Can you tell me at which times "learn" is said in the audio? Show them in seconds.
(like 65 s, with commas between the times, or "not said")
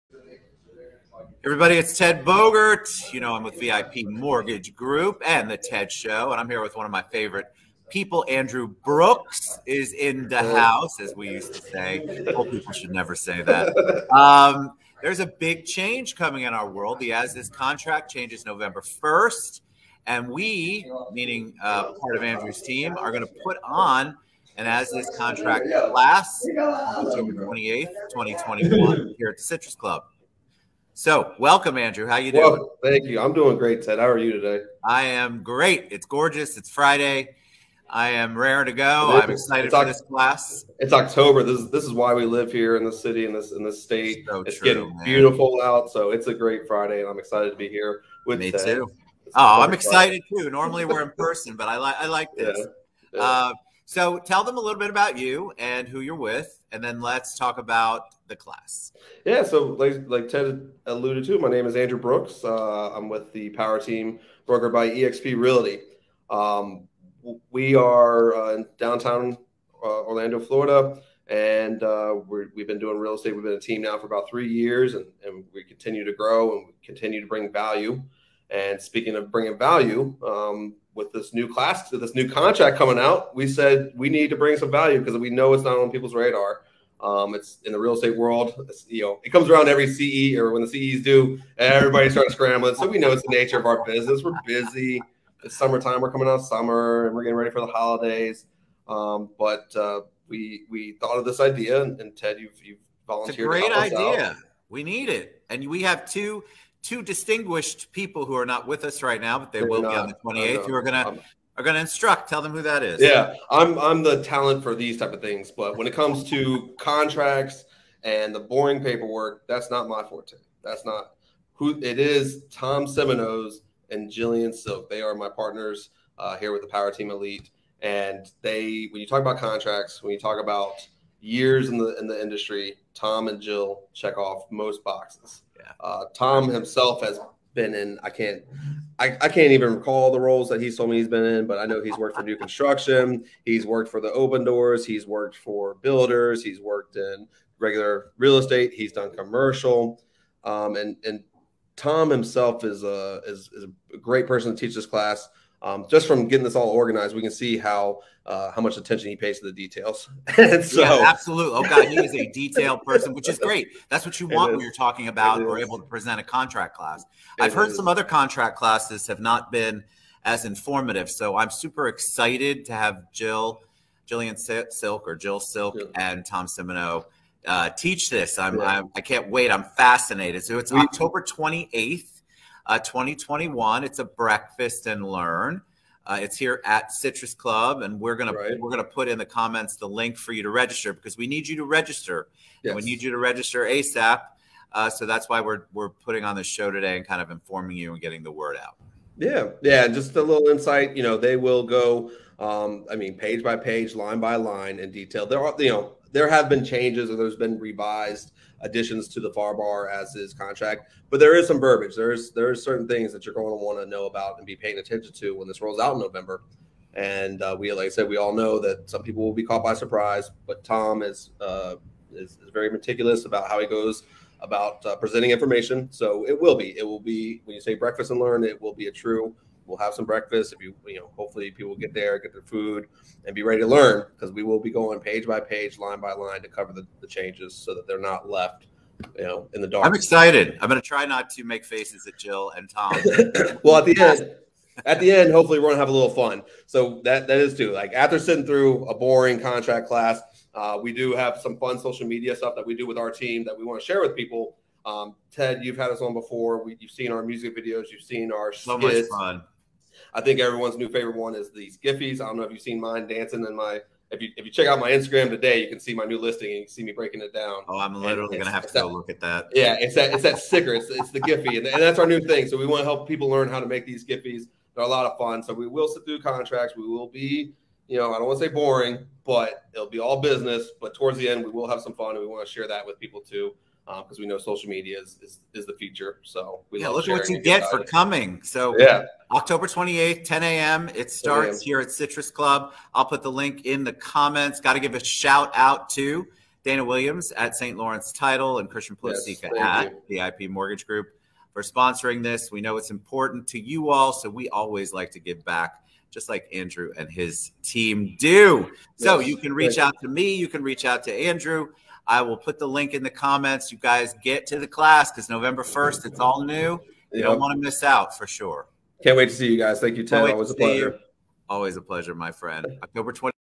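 185 s, 228 s, 233 s, 273 s.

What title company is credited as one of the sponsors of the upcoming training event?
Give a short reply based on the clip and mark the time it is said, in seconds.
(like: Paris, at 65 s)
St. Lawrence Title, at 297 s.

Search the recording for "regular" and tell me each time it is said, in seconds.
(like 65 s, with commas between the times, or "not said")
147 s.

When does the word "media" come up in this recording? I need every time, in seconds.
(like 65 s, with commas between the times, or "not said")
252 s, 284 s.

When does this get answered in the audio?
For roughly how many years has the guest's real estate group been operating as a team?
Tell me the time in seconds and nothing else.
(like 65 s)
74 s.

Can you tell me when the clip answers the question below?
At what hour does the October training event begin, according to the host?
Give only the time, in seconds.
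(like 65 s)
290 s.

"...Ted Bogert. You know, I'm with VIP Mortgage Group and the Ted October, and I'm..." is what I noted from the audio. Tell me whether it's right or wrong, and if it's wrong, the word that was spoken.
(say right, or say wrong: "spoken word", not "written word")
wrong: "Show", not "October".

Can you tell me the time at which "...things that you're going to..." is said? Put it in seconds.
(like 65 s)
212 s.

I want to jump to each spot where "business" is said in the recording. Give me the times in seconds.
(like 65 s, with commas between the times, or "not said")
93 s, 280 s.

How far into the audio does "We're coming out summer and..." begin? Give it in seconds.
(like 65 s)
96 s.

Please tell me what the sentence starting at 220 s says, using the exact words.
But Tom is uh, is, is, very meticulous about how he goes about uh, presenting information.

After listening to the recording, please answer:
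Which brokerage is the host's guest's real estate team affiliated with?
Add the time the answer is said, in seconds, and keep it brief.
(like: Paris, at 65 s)
EXP Realty, at 64 s.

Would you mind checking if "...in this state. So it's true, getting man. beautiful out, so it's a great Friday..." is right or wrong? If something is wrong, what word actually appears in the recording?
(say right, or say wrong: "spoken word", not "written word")
right.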